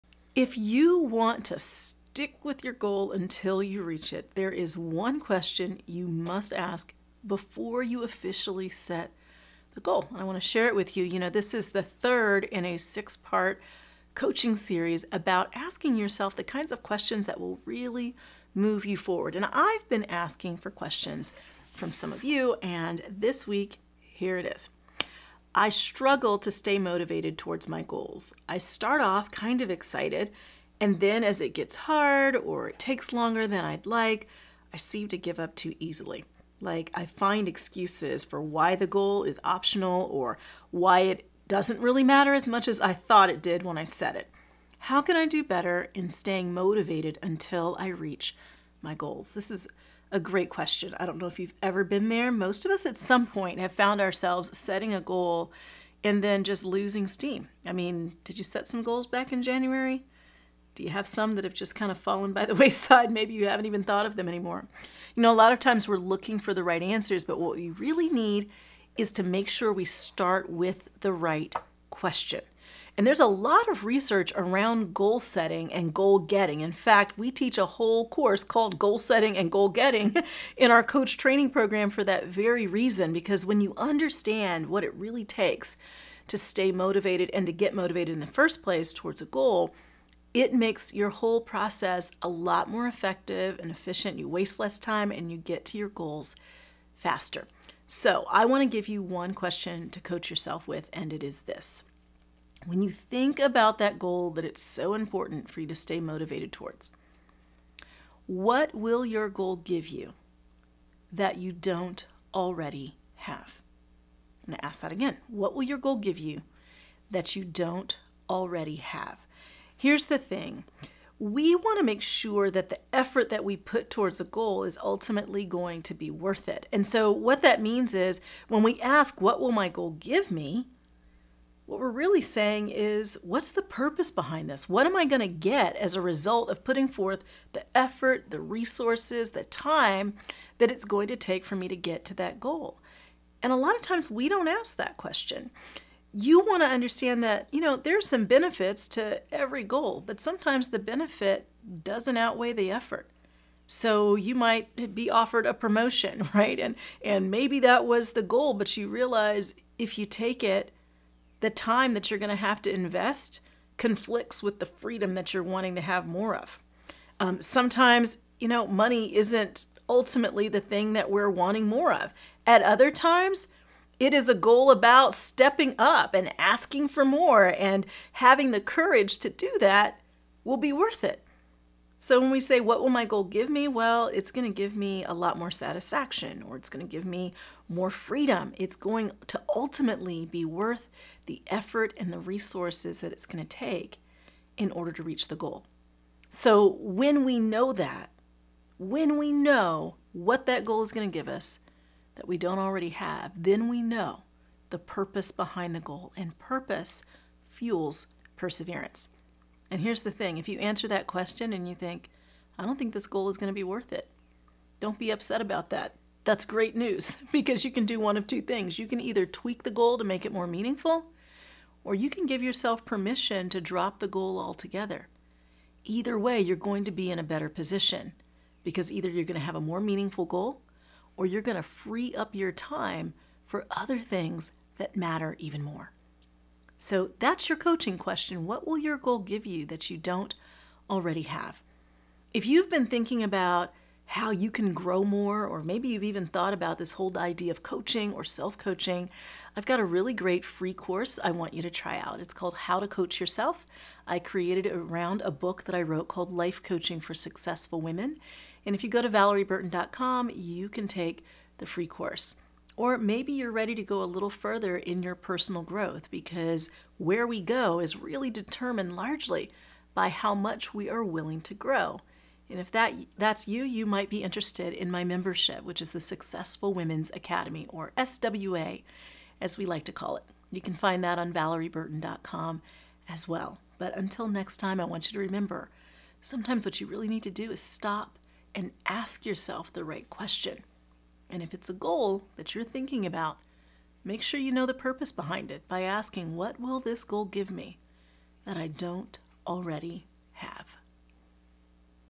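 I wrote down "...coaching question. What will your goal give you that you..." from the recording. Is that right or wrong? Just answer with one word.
right.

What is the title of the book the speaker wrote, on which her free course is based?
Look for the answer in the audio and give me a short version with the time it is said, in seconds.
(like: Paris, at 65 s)
Life Coaching for Successful Women, at 256 s.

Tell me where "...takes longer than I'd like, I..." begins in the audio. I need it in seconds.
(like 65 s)
32 s.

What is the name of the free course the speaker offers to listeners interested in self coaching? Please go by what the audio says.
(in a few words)
How to Coach Yourself.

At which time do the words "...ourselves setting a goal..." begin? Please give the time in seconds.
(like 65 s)
54 s.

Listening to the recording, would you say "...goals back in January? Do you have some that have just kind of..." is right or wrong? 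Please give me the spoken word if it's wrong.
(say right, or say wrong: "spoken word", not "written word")
right.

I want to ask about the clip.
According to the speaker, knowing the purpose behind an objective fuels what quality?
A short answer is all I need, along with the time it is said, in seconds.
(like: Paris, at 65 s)
perseverance, at 208 s.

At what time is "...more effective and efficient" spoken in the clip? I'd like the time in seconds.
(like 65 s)
92 s.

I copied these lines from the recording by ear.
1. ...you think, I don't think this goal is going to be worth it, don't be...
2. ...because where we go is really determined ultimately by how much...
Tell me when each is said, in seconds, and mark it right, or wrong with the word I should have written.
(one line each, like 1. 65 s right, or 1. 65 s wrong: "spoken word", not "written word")
1. 211 s right
2. 266 s wrong: "largely", not "ultimately".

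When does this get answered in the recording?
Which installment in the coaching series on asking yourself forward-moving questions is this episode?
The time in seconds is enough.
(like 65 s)
11 s.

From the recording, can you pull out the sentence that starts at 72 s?
And there's a lot of research around goal setting and goal getting.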